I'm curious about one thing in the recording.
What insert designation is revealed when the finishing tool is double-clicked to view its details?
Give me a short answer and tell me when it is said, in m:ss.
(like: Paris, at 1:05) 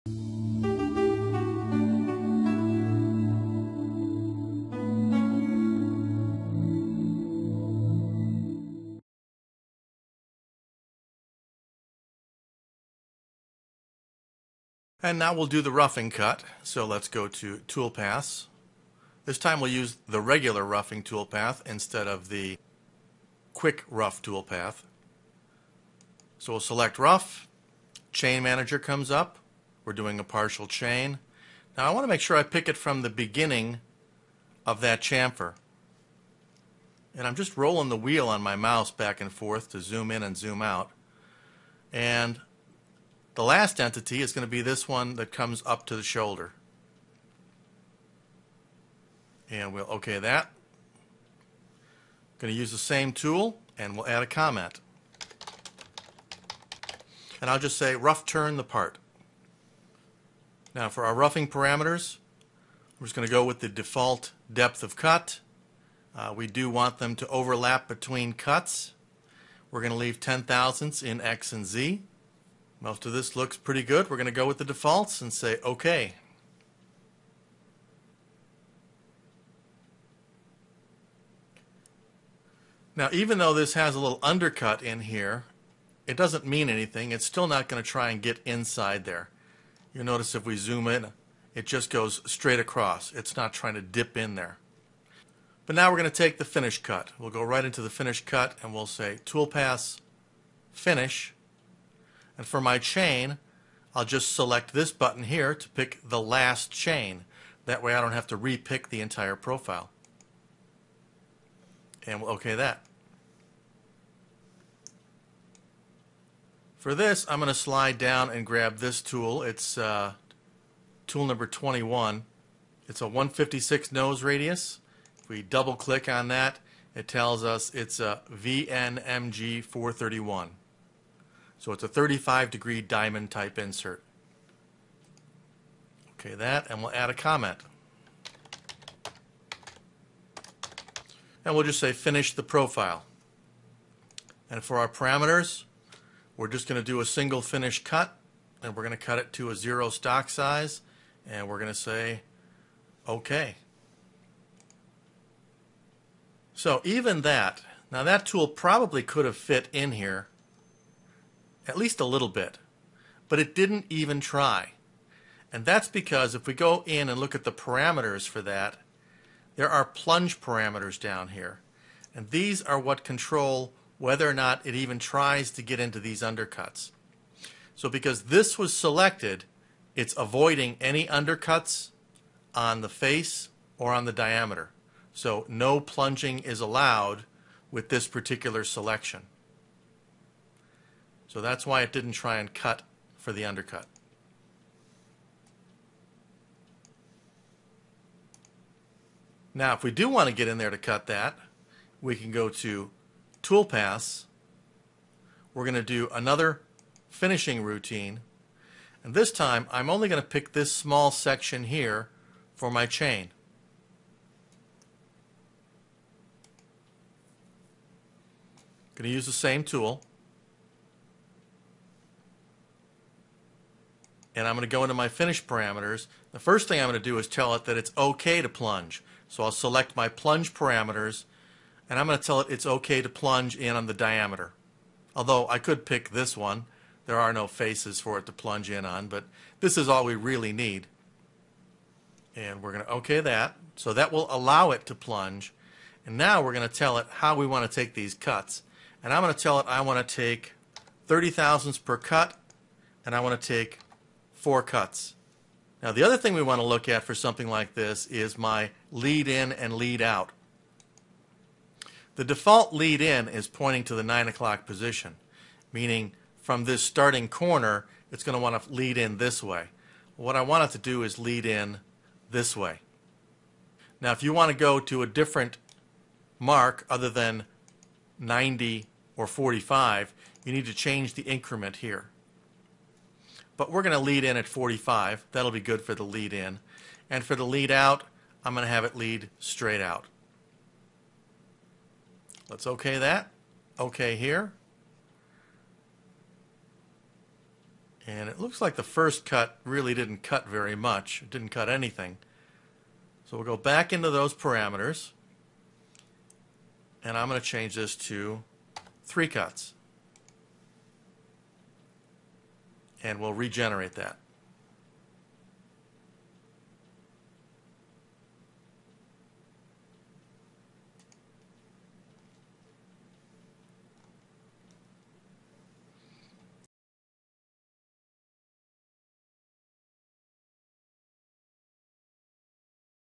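VNMG 431, at 2:08.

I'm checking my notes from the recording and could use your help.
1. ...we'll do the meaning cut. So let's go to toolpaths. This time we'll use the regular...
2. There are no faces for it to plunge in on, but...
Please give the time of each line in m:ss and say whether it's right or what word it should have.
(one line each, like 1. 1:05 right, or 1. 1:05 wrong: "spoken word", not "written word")
1. 0:15 wrong: "roughing", not "meaning"
2. 3:57 right.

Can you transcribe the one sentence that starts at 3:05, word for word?
So no plunging is allowed with this particular selection.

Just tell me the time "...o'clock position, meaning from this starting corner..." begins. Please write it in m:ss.
4:24.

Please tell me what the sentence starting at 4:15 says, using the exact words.
Now, the other thing we want to look at for something like this is my lead in and lead out.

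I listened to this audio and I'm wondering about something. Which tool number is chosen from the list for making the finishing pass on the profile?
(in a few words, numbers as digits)
21.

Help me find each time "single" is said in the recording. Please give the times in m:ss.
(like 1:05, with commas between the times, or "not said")
2:27.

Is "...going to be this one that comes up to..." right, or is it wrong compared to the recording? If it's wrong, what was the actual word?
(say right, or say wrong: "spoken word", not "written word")
right.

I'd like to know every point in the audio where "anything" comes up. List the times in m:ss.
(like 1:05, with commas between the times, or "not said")
1:26, 5:01.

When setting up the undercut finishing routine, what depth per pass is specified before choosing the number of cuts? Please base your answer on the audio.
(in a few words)
30 thousandths.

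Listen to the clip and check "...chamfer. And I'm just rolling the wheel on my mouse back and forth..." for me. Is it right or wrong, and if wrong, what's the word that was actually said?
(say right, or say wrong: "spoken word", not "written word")
right.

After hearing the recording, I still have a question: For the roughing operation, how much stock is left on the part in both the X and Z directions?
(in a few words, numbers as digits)
10 thousandths.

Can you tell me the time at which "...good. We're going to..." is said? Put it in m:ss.
1:13.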